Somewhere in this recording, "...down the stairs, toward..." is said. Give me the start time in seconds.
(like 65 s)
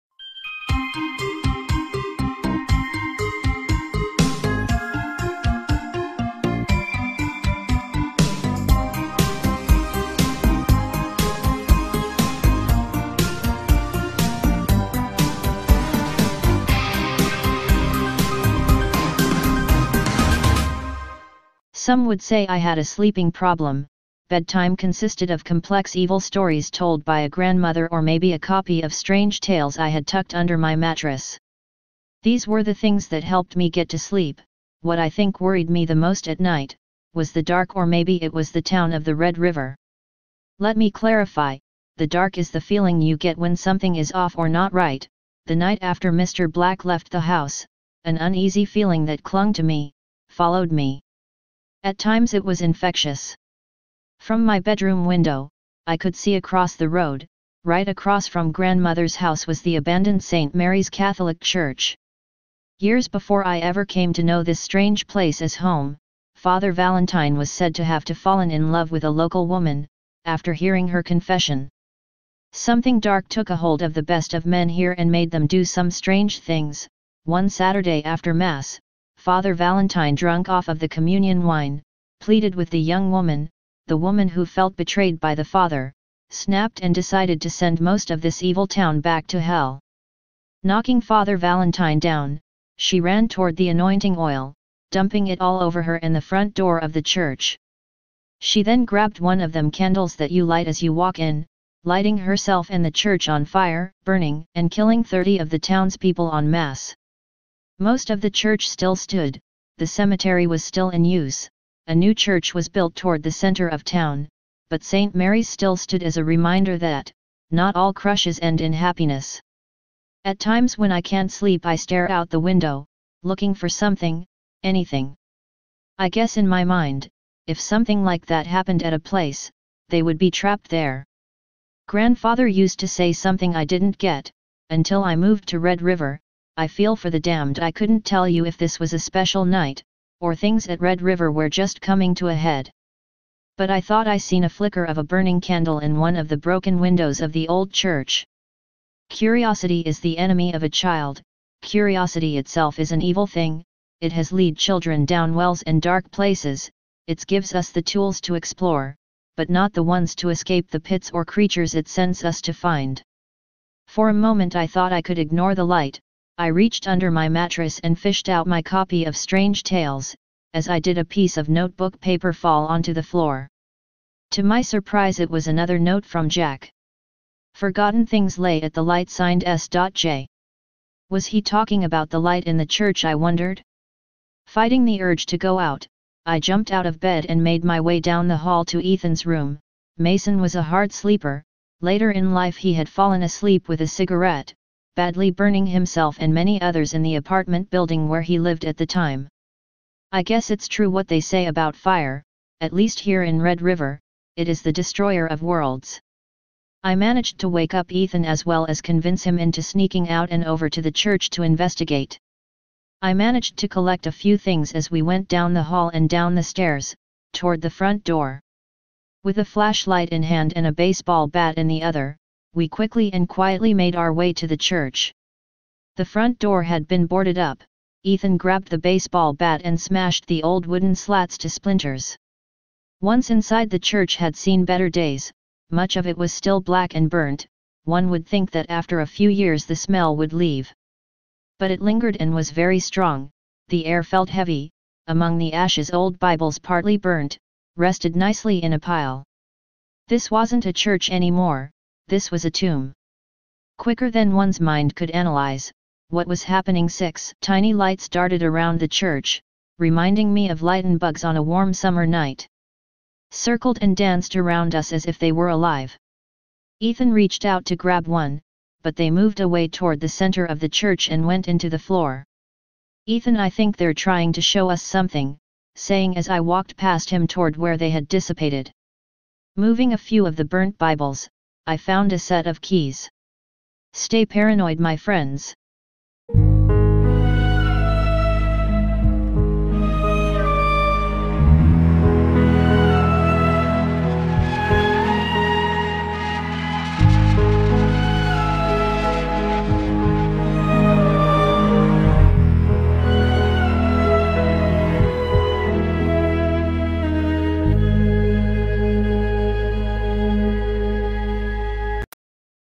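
216 s.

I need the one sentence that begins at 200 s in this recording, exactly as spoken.
I guess it's true what they say about fire, at least here in Red River, it is the destroyer of worlds.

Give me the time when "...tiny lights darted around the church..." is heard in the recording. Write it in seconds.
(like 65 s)
257 s.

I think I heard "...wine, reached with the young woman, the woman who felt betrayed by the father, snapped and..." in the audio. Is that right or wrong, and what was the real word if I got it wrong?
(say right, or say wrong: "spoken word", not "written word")
wrong: "pleaded", not "reached".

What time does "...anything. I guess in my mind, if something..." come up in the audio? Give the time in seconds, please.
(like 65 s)
124 s.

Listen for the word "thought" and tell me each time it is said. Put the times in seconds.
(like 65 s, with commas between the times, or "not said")
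143 s, 164 s.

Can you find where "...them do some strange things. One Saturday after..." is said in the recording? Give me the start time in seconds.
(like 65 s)
75 s.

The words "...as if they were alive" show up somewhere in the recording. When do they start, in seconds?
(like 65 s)
264 s.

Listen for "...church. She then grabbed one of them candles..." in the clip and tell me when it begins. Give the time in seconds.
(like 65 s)
97 s.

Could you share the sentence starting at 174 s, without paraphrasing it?
To my surprise it was another note from Jack.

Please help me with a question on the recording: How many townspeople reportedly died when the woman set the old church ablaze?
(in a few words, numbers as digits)
30.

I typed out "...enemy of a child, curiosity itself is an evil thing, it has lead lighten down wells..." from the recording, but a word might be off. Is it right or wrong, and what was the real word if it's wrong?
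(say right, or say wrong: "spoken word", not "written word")
wrong: "children", not "lighten".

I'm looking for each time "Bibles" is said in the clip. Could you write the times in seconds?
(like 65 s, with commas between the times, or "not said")
246 s, 280 s.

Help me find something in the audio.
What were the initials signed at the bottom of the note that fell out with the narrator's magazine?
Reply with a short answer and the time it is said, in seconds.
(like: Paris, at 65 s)
S.J., at 179 s.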